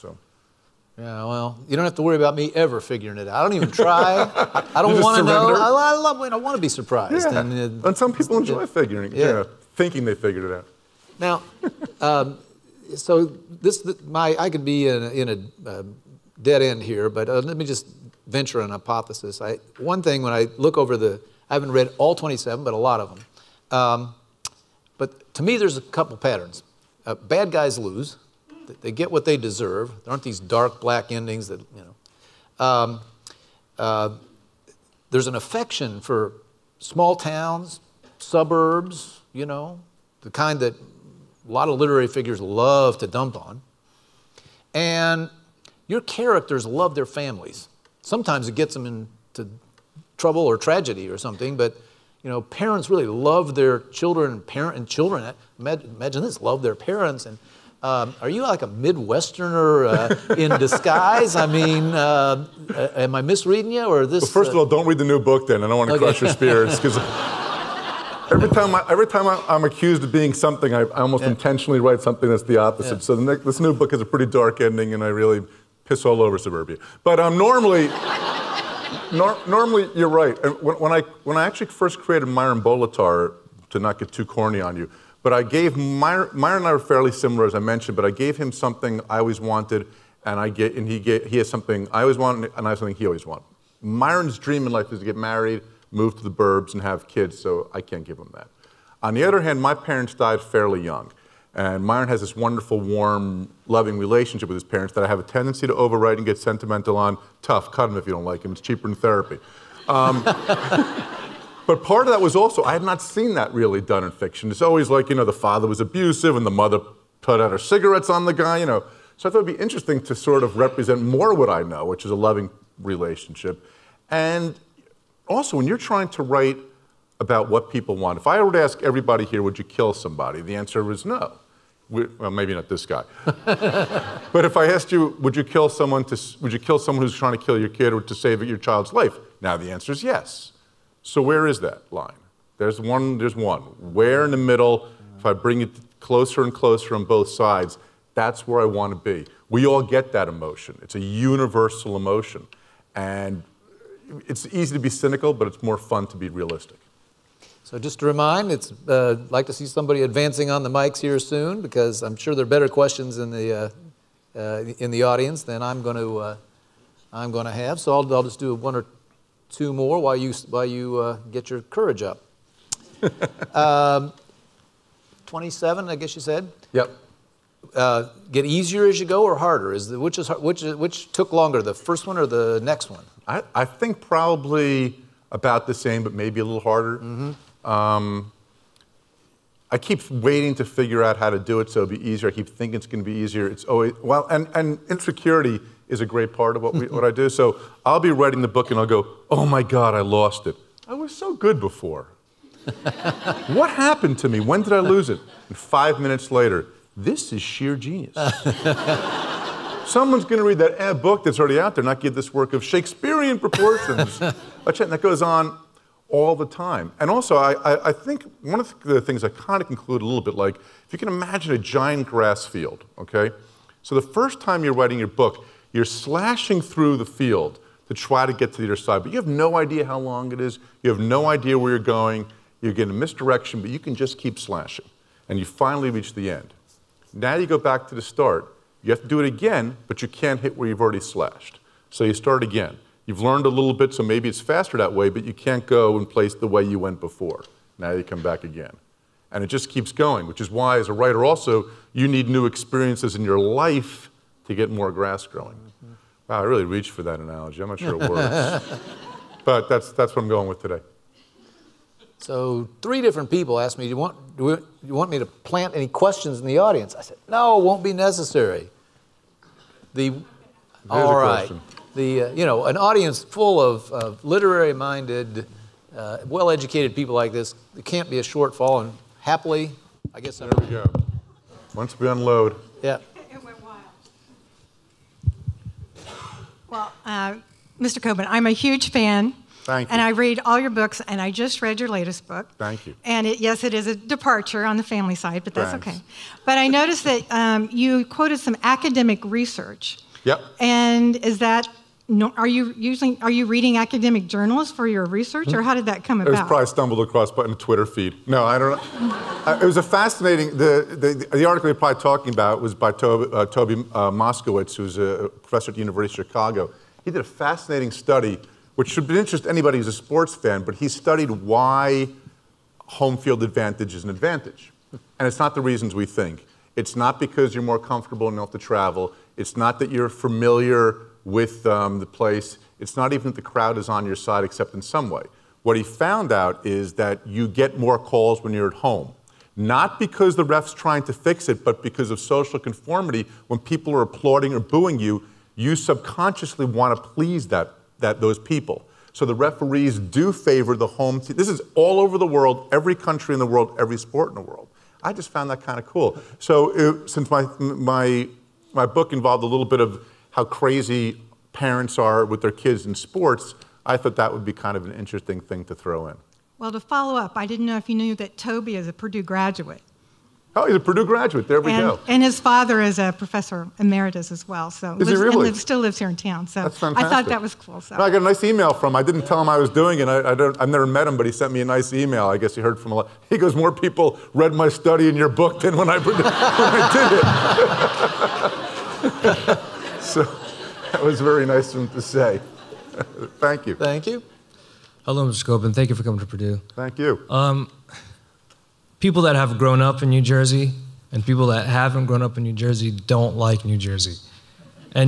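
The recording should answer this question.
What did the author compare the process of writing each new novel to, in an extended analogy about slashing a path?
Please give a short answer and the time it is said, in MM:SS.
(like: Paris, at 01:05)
a giant grass field, at 03:41.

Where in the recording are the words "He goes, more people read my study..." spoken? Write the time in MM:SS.
06:23.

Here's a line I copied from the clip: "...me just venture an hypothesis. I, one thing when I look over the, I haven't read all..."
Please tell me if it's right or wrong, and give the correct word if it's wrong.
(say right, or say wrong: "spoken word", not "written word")
right.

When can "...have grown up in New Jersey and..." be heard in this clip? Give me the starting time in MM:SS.
06:39.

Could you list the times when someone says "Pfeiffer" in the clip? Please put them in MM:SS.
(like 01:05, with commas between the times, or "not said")
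not said.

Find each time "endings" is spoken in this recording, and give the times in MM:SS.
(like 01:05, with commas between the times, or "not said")
00:31, 01:14.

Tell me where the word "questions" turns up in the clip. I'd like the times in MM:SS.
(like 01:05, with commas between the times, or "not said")
02:42, 04:25, 04:31.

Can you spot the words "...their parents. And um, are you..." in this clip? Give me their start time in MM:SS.
00:56.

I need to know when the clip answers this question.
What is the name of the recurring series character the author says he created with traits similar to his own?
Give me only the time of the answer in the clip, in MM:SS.
01:22.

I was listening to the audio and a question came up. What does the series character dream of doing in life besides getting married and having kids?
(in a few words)
move to the burbs.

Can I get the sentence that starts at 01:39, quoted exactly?
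On the other hand, my parents died fairly young.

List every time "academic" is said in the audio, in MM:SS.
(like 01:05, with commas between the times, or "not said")
04:58, 05:03.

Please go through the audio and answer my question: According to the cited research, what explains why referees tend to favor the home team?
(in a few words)
social conformity.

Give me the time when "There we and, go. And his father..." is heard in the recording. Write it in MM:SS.
06:11.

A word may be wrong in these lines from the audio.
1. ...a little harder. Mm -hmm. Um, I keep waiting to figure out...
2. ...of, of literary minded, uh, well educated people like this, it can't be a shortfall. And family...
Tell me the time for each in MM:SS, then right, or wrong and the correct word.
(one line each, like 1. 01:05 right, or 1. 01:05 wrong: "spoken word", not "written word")
1. 03:06 right
2. 04:33 wrong: "happily", not "family".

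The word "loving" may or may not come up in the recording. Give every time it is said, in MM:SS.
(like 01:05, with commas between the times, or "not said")
01:43, 02:02.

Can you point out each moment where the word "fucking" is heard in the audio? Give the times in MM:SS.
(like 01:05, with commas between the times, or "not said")
not said.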